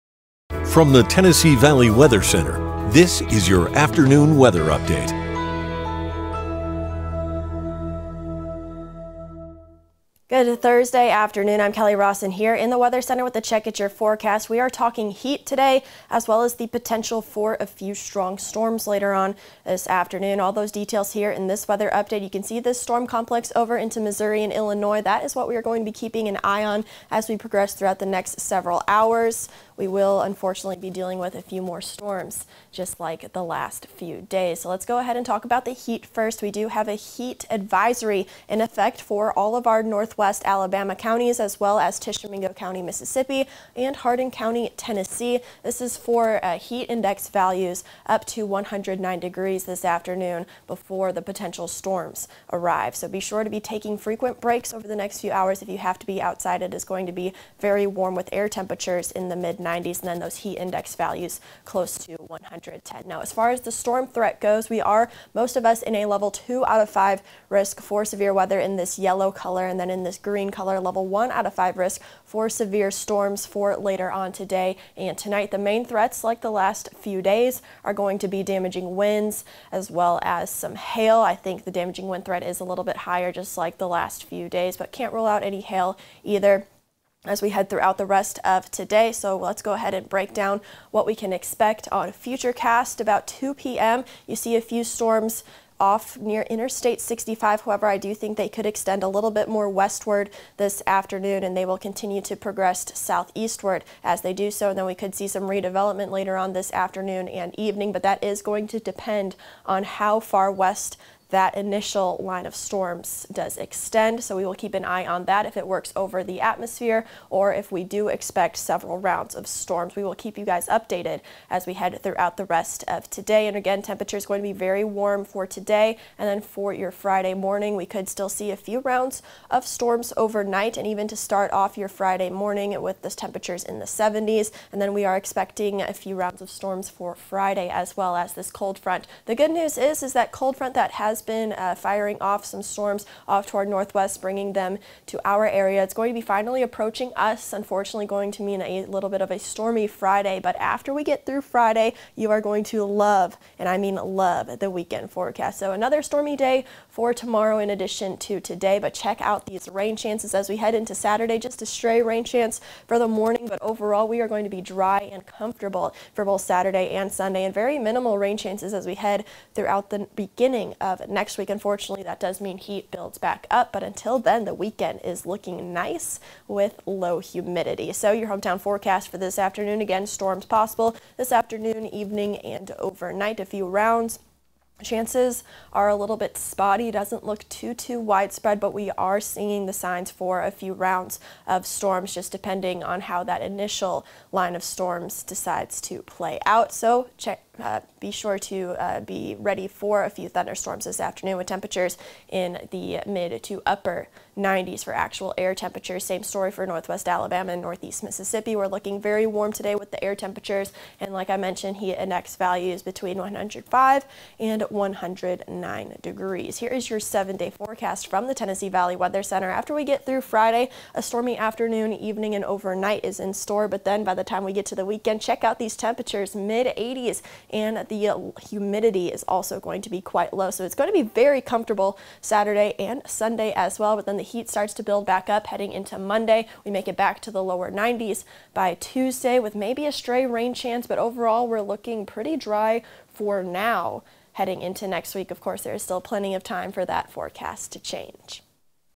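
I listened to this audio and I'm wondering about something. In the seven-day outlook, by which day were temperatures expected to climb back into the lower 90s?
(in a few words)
Tuesday.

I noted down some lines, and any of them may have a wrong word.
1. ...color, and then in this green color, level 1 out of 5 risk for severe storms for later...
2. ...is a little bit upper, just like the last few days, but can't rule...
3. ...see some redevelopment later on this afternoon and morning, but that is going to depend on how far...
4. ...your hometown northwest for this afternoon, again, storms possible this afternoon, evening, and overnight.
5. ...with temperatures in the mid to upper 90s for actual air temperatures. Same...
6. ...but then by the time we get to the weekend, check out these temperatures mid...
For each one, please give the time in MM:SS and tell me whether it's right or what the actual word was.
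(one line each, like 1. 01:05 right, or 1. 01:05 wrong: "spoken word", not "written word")
1. 01:09 right
2. 01:22 wrong: "higher", not "upper"
3. 01:45 wrong: "evening", not "morning"
4. 02:58 wrong: "forecast", not "northwest"
5. 03:21 right
6. 03:43 right.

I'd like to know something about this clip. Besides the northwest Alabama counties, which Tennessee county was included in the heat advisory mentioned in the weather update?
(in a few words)
Hardin County.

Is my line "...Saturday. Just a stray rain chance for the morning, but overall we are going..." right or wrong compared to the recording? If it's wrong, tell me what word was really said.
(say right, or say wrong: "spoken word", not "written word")
right.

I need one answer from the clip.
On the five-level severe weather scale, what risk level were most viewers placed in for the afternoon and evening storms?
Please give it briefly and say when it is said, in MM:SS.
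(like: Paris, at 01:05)
Level 2, at 01:06.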